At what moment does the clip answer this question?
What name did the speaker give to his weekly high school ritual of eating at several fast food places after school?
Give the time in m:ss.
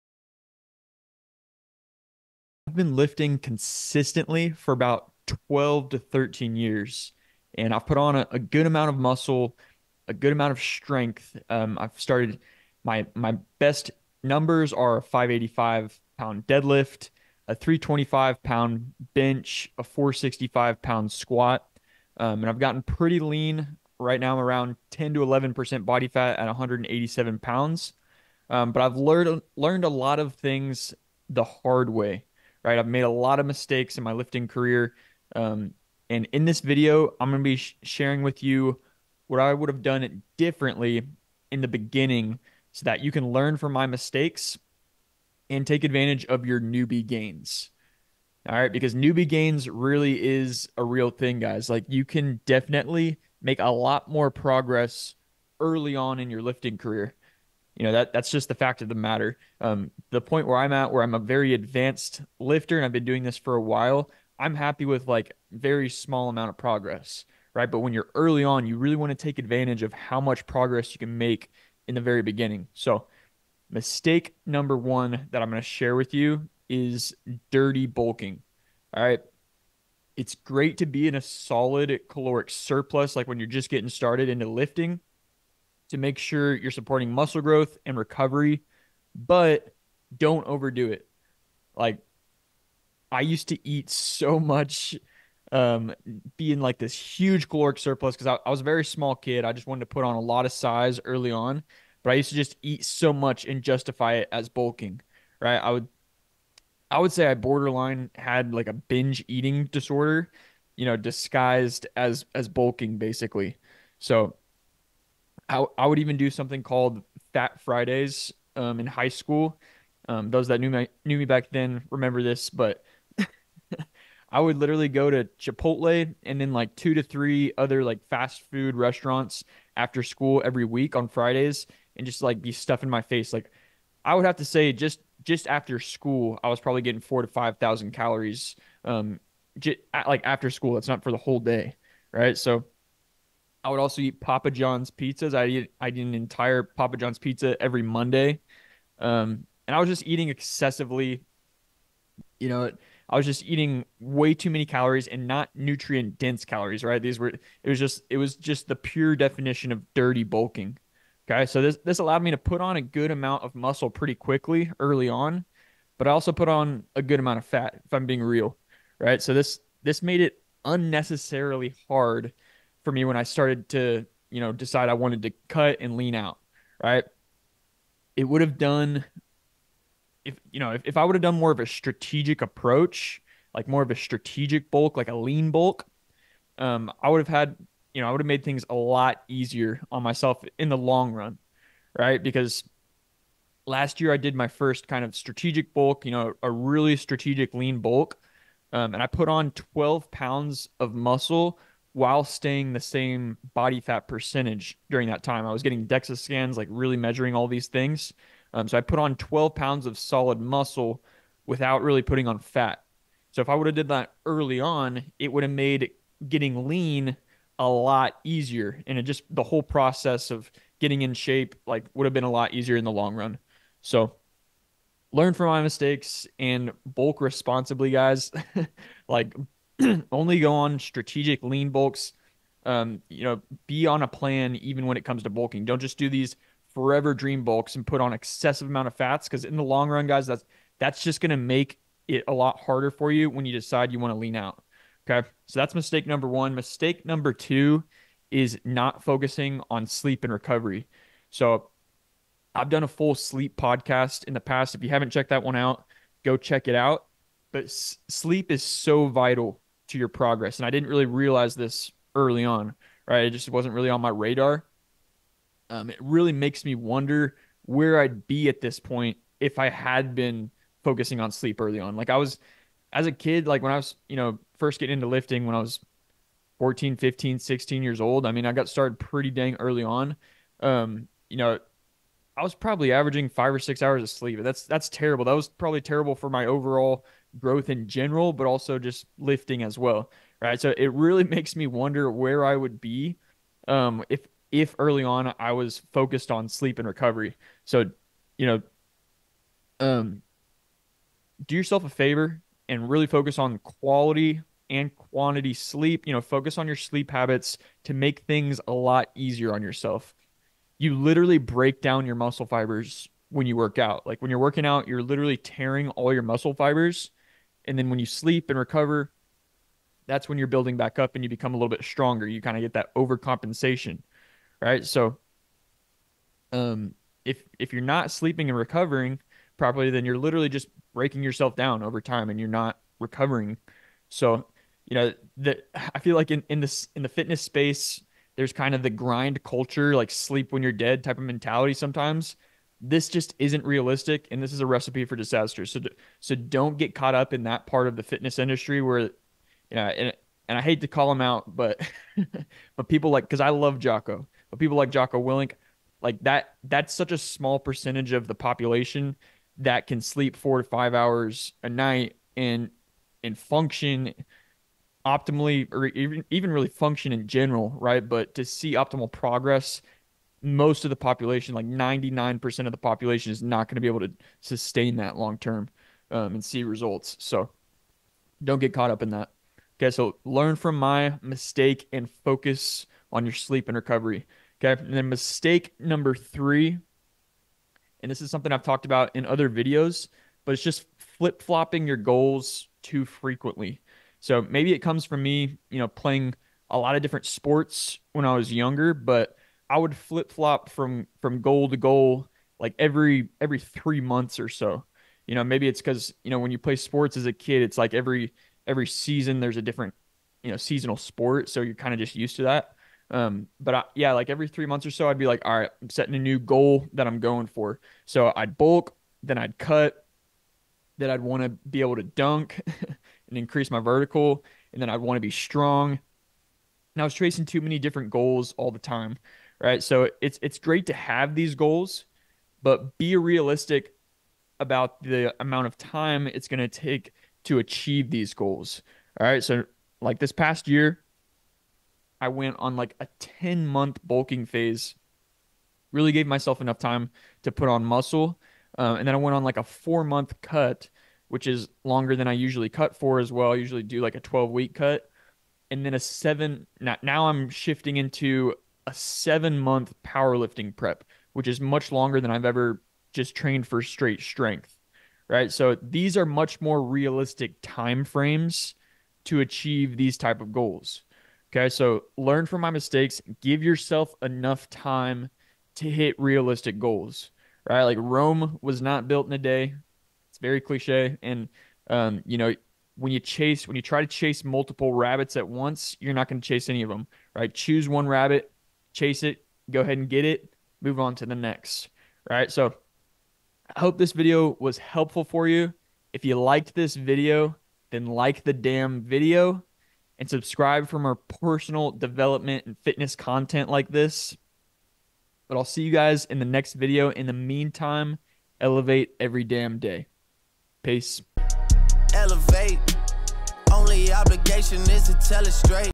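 1:57.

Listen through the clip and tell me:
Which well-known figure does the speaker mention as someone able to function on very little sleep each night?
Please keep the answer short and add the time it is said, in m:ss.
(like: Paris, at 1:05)
Jocko Willink, at 5:54.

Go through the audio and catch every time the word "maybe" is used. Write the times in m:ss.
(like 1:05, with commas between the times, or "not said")
6:34, 6:45.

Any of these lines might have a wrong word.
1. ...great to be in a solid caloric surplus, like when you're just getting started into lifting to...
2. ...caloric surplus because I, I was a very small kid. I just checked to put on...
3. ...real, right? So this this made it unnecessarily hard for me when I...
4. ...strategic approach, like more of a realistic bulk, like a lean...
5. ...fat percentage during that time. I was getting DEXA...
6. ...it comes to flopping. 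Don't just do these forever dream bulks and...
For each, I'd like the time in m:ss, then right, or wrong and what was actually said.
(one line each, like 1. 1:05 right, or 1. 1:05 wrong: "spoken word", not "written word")
1. 1:20 right
2. 1:37 wrong: "wanted", not "checked"
3. 2:48 right
4. 3:01 wrong: "strategic", not "realistic"
5. 3:23 right
6. 3:54 wrong: "bulking", not "flopping".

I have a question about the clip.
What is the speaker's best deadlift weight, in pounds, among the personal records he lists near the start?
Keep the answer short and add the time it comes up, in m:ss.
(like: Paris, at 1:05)
585, at 0:15.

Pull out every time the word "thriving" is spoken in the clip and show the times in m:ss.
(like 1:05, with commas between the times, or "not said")
not said.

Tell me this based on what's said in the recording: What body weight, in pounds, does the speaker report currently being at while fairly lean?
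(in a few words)
187.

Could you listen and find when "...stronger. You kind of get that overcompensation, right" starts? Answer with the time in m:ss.
5:21.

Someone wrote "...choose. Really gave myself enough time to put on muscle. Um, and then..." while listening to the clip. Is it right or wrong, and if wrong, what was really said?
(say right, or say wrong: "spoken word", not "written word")
wrong: "phase", not "choose".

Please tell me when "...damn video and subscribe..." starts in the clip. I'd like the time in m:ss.
8:18.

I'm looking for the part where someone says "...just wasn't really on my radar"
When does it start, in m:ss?
4:23.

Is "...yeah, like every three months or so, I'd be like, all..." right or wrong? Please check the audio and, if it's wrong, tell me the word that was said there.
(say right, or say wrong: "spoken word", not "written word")
right.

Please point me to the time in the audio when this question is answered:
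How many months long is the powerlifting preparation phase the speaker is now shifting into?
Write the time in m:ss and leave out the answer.
7:38.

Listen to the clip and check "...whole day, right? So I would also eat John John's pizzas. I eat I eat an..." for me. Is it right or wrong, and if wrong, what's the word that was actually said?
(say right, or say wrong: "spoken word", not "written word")
wrong: "Papa", not "John".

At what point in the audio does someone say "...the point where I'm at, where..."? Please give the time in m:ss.
1:00.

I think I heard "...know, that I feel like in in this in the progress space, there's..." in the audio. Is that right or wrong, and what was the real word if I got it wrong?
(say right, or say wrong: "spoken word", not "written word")
wrong: "fitness", not "progress".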